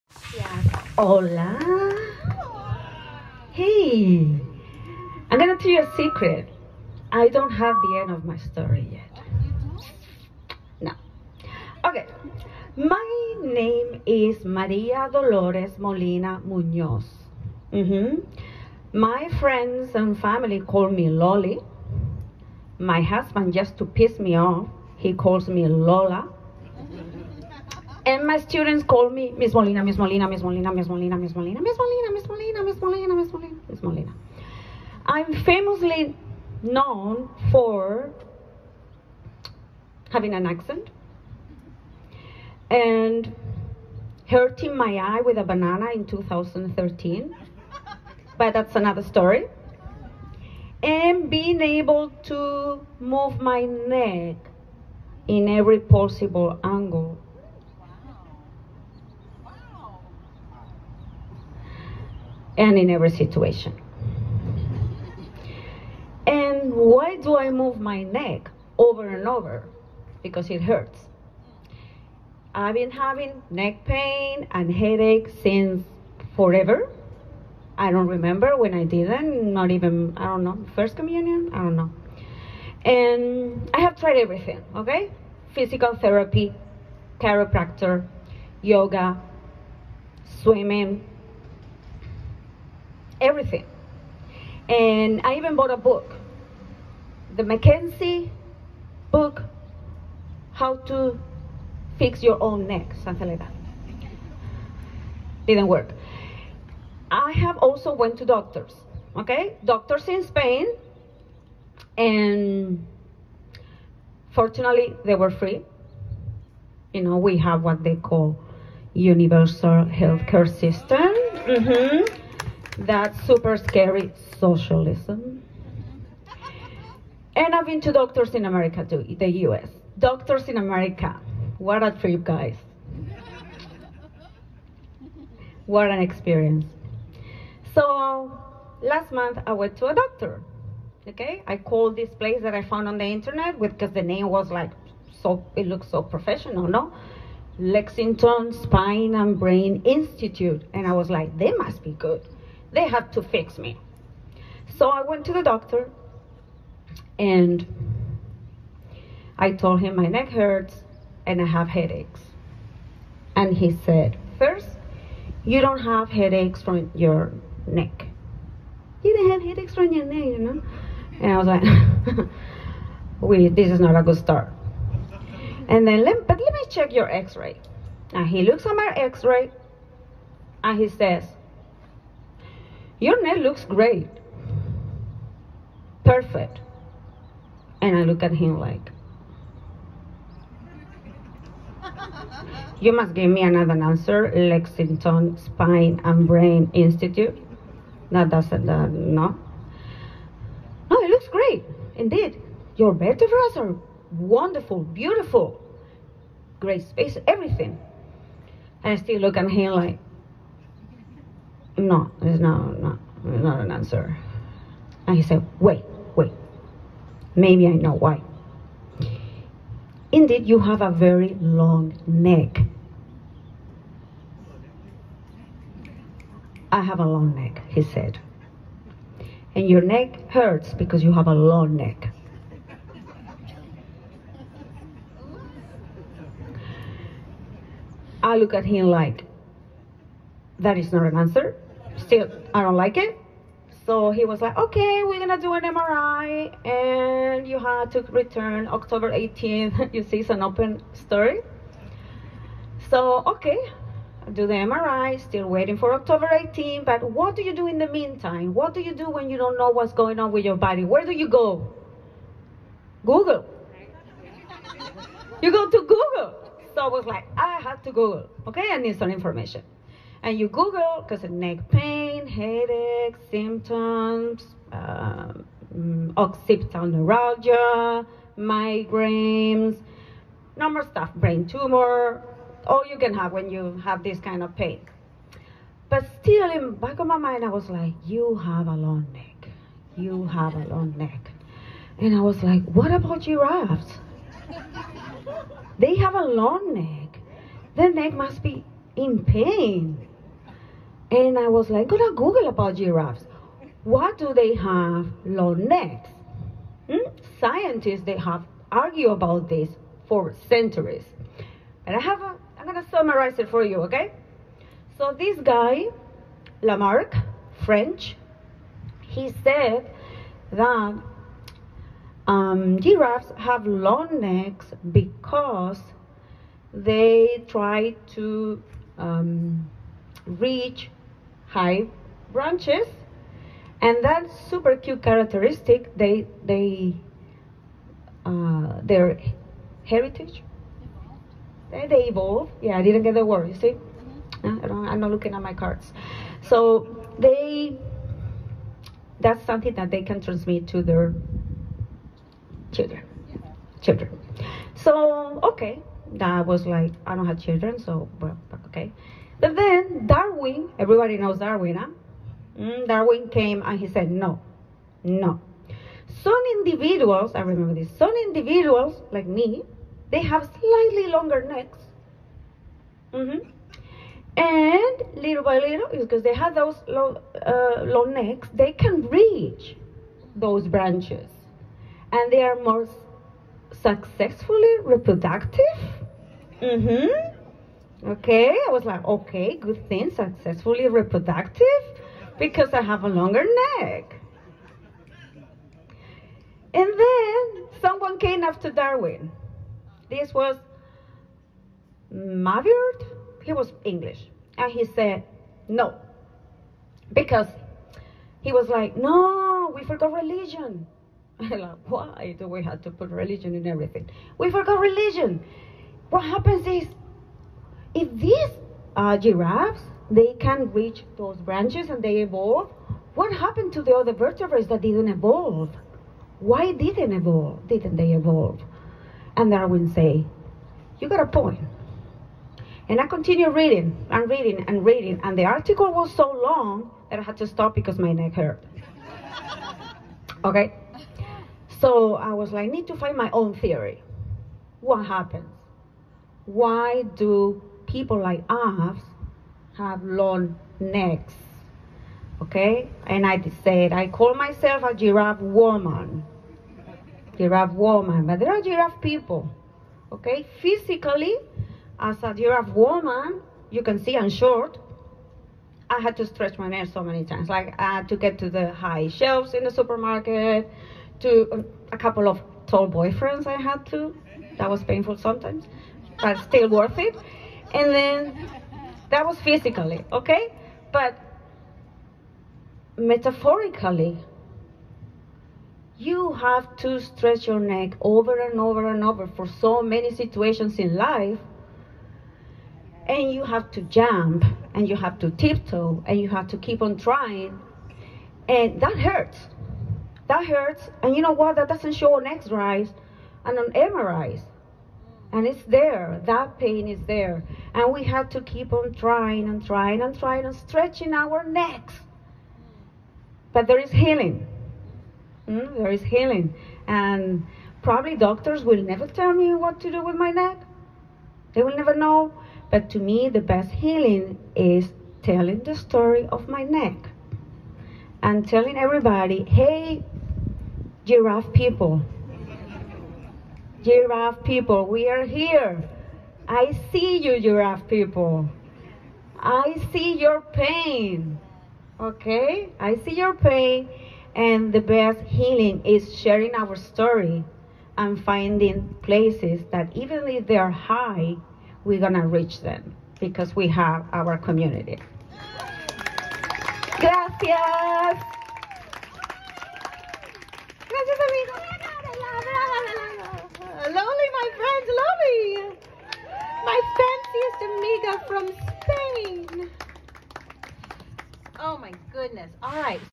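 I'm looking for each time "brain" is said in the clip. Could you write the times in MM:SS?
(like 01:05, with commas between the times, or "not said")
02:29, 03:16, 04:41.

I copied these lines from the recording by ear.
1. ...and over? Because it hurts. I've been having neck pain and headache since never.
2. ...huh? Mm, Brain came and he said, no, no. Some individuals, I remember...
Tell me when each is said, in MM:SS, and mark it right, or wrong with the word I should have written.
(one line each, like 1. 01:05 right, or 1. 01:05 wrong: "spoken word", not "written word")
1. 01:09 wrong: "forever", not "never"
2. 06:01 wrong: "Darwin", not "Brain".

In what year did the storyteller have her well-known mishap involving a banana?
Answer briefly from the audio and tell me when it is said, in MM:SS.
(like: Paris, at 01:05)
2013, at 00:46.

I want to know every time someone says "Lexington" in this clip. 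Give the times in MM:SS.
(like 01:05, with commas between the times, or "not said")
02:27, 03:14.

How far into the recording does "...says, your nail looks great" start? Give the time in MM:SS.
03:00.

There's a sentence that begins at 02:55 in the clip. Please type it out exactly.
And then, let, but let me check your x-ray.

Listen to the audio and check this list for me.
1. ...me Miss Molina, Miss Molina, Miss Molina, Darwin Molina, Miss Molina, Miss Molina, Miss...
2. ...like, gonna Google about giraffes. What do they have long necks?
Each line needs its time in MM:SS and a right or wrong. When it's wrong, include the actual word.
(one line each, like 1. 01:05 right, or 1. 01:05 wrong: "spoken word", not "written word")
1. 00:29 wrong: "Miss", not "Darwin"
2. 05:01 right.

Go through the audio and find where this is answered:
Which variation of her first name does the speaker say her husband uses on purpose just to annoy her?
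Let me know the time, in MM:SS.
00:25.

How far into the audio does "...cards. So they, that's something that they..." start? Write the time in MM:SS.
05:45.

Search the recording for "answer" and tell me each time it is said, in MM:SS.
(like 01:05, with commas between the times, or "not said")
03:13, 03:33, 04:01.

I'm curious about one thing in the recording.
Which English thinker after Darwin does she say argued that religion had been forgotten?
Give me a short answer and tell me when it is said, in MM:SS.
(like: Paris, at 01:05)
Mivart, at 06:42.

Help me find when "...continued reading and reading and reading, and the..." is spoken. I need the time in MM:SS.
07:13.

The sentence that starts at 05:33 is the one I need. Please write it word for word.
And that super cute characteristic, they, they, uh, their heritage, they, they evolve.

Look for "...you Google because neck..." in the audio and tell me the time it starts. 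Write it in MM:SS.
04:30.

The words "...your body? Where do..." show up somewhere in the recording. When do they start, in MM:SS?
04:20.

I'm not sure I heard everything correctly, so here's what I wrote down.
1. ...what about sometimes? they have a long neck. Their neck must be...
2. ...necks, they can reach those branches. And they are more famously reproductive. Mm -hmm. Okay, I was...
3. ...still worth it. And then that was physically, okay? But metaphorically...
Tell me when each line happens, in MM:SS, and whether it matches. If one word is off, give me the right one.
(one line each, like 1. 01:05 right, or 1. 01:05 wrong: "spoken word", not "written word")
1. 04:52 wrong: "giraffes", not "sometimes"
2. 06:18 wrong: "successfully", not "famously"
3. 07:56 right.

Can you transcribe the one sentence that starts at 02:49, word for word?
You didn't have headaches from your neck, you know?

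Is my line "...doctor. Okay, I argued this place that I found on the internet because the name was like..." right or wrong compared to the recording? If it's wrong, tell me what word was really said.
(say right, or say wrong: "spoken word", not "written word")
wrong: "called", not "argued".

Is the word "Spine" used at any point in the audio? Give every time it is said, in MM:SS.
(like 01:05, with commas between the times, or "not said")
02:28, 03:15.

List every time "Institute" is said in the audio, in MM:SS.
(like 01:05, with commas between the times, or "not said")
02:29, 03:16.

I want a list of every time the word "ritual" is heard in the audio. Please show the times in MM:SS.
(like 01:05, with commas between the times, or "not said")
not said.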